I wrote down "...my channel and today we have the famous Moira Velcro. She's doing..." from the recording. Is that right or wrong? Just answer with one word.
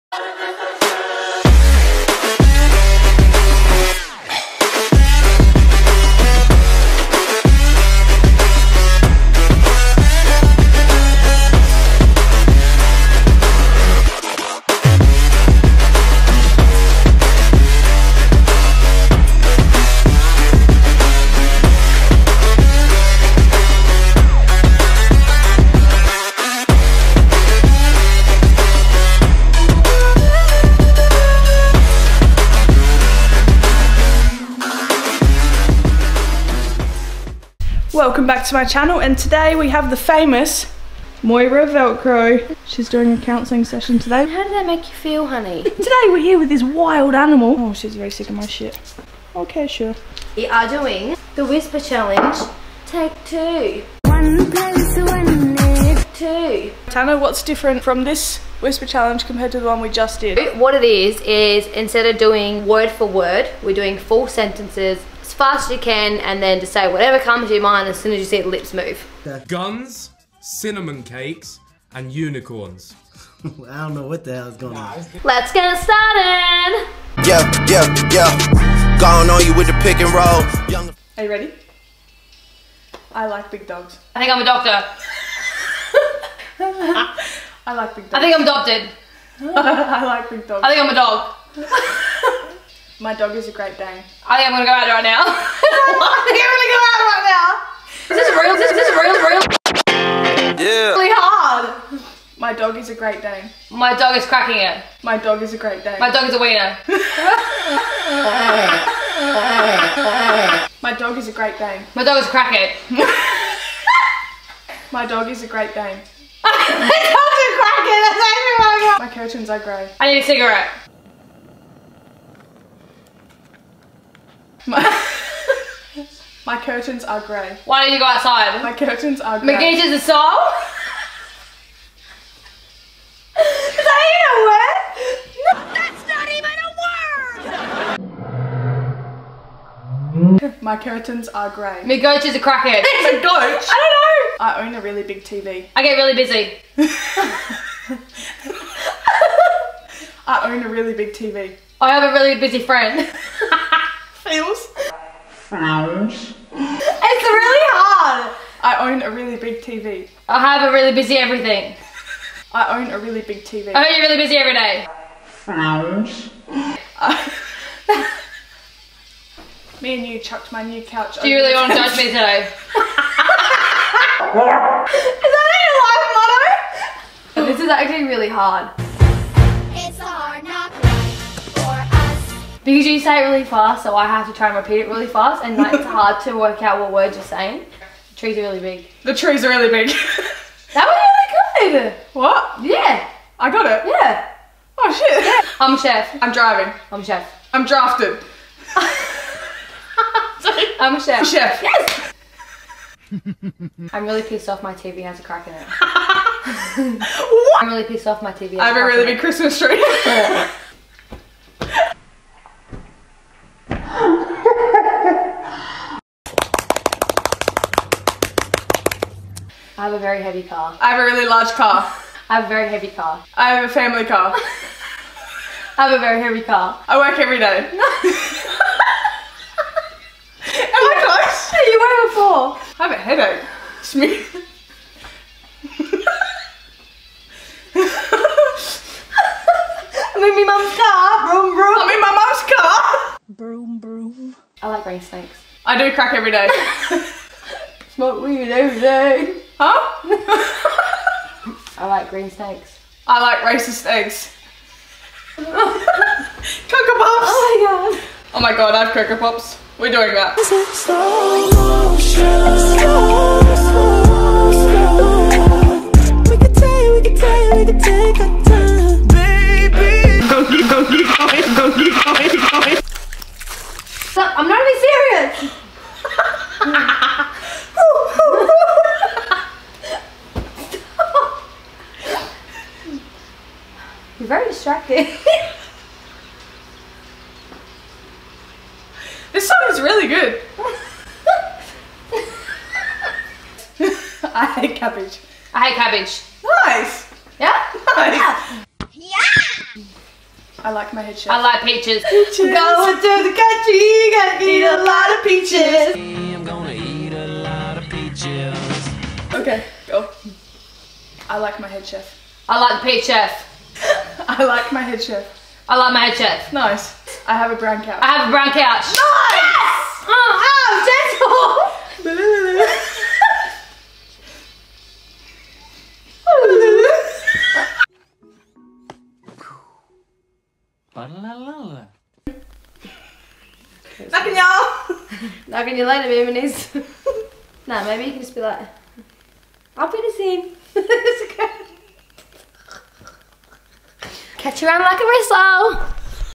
right.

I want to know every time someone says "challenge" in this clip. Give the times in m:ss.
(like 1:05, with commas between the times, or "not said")
0:51, 0:58.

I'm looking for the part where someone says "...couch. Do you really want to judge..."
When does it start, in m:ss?
2:50.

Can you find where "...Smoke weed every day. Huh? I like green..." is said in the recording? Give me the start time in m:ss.
4:07.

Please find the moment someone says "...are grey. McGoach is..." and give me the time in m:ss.
2:21.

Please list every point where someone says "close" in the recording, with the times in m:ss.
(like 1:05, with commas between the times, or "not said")
3:51.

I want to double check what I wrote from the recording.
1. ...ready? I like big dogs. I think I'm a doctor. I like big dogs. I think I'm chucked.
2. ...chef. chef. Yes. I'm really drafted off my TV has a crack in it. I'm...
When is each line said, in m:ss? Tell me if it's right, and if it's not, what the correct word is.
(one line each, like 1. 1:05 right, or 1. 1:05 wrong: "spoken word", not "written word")
1. 1:21 wrong: "adopted", not "chucked"
2. 3:21 wrong: "pissed", not "drafted".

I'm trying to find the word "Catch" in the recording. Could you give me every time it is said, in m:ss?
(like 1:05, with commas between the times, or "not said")
5:44.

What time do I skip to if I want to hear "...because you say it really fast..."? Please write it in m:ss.
3:02.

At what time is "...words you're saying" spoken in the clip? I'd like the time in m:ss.
3:06.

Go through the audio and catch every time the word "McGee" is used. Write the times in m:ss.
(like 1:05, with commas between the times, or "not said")
2:09.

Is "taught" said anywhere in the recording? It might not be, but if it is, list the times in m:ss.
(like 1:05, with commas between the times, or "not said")
not said.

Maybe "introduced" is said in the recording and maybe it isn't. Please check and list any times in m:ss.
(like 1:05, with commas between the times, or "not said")
not said.